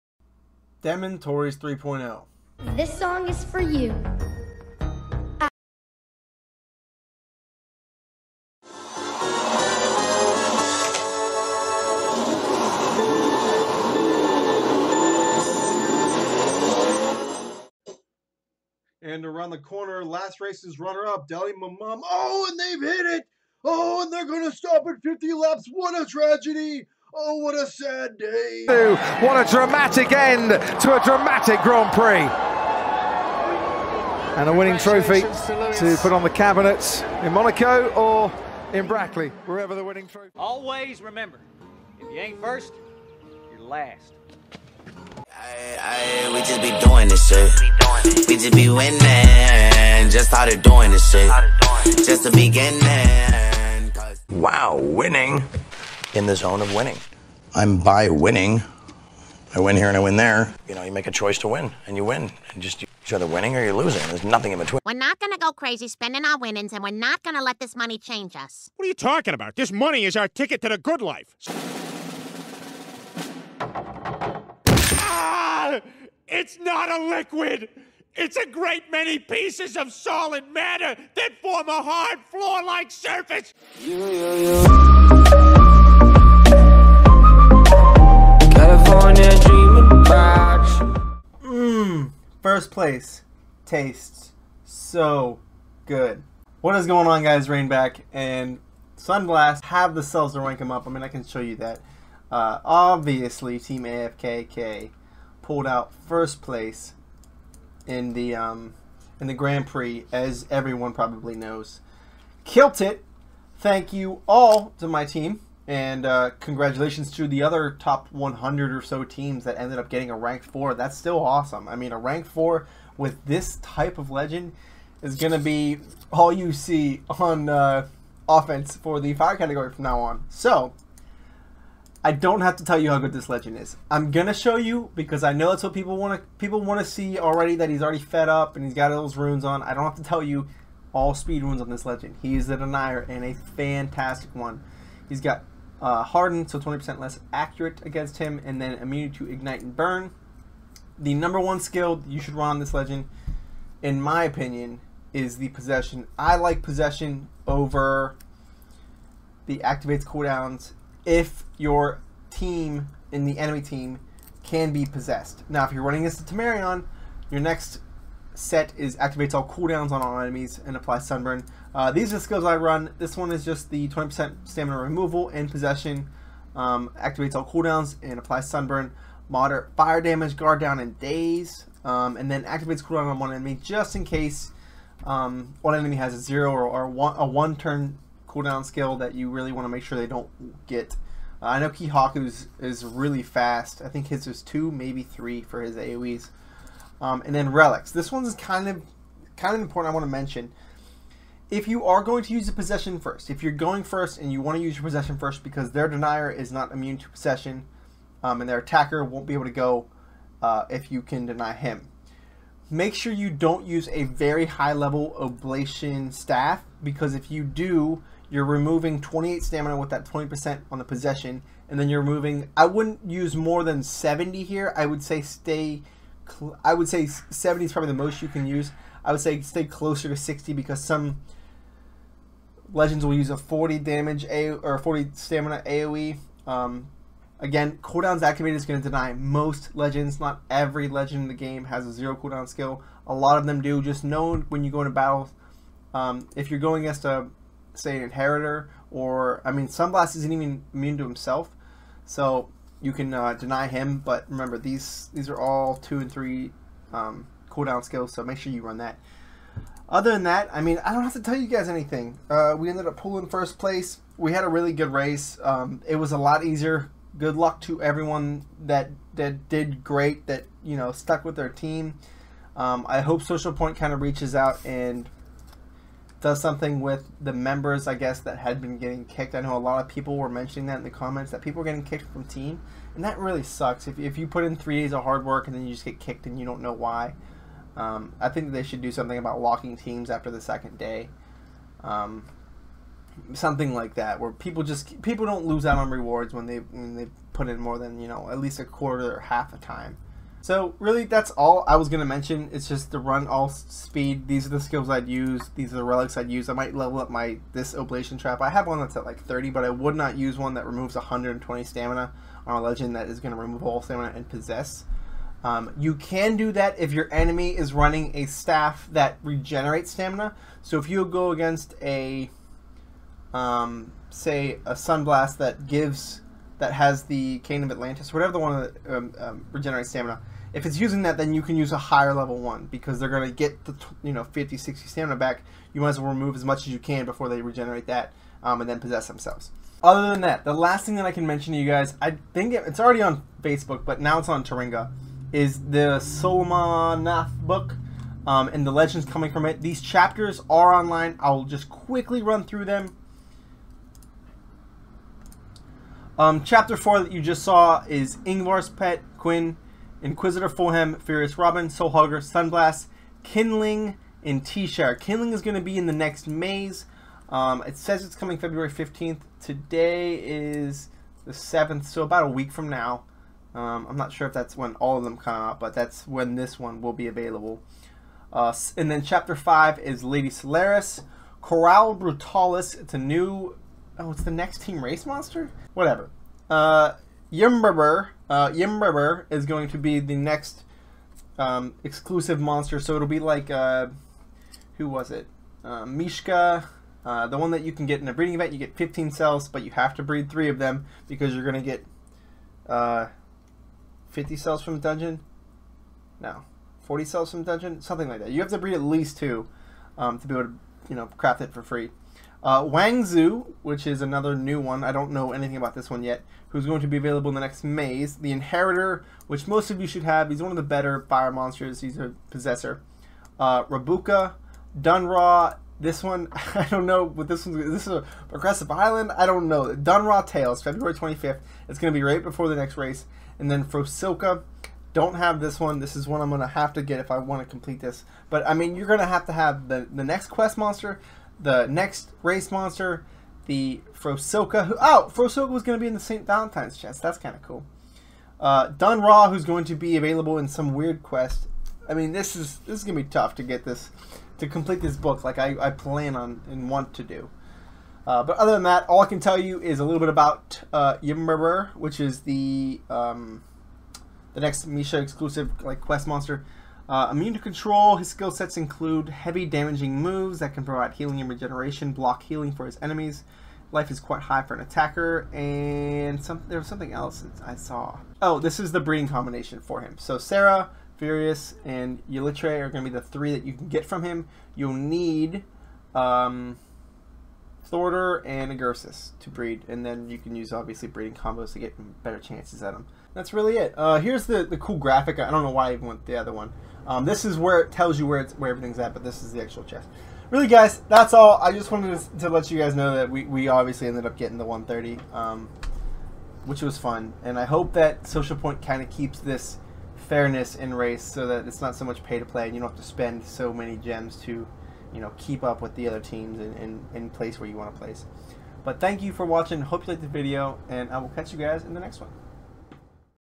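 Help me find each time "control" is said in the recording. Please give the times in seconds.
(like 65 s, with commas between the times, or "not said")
467 s.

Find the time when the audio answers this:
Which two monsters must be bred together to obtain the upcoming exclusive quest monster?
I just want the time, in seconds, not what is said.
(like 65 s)
487 s.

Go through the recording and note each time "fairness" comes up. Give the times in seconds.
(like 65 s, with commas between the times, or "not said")
510 s.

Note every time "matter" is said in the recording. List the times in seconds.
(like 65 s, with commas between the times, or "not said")
80 s.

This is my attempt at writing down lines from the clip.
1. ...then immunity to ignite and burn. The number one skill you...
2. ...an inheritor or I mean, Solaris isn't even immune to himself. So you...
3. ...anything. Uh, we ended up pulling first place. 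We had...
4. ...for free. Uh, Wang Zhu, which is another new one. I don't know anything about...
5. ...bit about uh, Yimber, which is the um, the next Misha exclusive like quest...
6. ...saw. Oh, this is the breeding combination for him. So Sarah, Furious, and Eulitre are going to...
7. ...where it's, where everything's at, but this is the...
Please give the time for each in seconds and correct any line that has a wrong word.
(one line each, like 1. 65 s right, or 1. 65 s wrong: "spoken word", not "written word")
1. 148 s right
2. 247 s wrong: "Sunblast", not "Solaris"
3. 261 s right
4. 411 s right
5. 459 s right
6. 477 s right
7. 498 s right.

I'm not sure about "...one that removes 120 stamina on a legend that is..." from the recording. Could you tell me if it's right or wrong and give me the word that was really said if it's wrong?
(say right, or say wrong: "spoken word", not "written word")
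right.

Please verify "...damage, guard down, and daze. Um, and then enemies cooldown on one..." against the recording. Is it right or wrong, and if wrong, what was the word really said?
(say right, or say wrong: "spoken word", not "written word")
wrong: "activates", not "enemies".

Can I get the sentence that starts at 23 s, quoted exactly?
Oh, and they're going to stop at 50 laps.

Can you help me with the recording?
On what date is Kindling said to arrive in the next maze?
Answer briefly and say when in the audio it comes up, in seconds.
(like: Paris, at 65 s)
February 15th, at 368 s.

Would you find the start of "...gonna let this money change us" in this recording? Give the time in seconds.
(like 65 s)
67 s.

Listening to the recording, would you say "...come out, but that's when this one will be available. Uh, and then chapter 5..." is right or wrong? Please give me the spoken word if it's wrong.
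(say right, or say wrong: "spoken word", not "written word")
right.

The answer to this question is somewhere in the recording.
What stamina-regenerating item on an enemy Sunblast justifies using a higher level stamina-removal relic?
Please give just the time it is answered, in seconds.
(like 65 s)
327 s.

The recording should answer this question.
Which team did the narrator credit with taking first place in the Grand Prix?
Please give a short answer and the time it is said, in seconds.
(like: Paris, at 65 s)
Team AFKK, at 103 s.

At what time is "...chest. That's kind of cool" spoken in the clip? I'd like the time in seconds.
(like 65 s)
446 s.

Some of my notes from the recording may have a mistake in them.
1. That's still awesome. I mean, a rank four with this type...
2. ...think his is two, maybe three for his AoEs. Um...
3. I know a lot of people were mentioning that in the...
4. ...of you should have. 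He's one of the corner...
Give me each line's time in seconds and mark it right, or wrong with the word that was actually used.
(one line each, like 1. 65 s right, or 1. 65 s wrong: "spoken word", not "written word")
1. 120 s right
2. 193 s right
3. 279 s right
4. 419 s wrong: "better", not "corner".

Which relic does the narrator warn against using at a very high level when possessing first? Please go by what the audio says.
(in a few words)
Oblation staff.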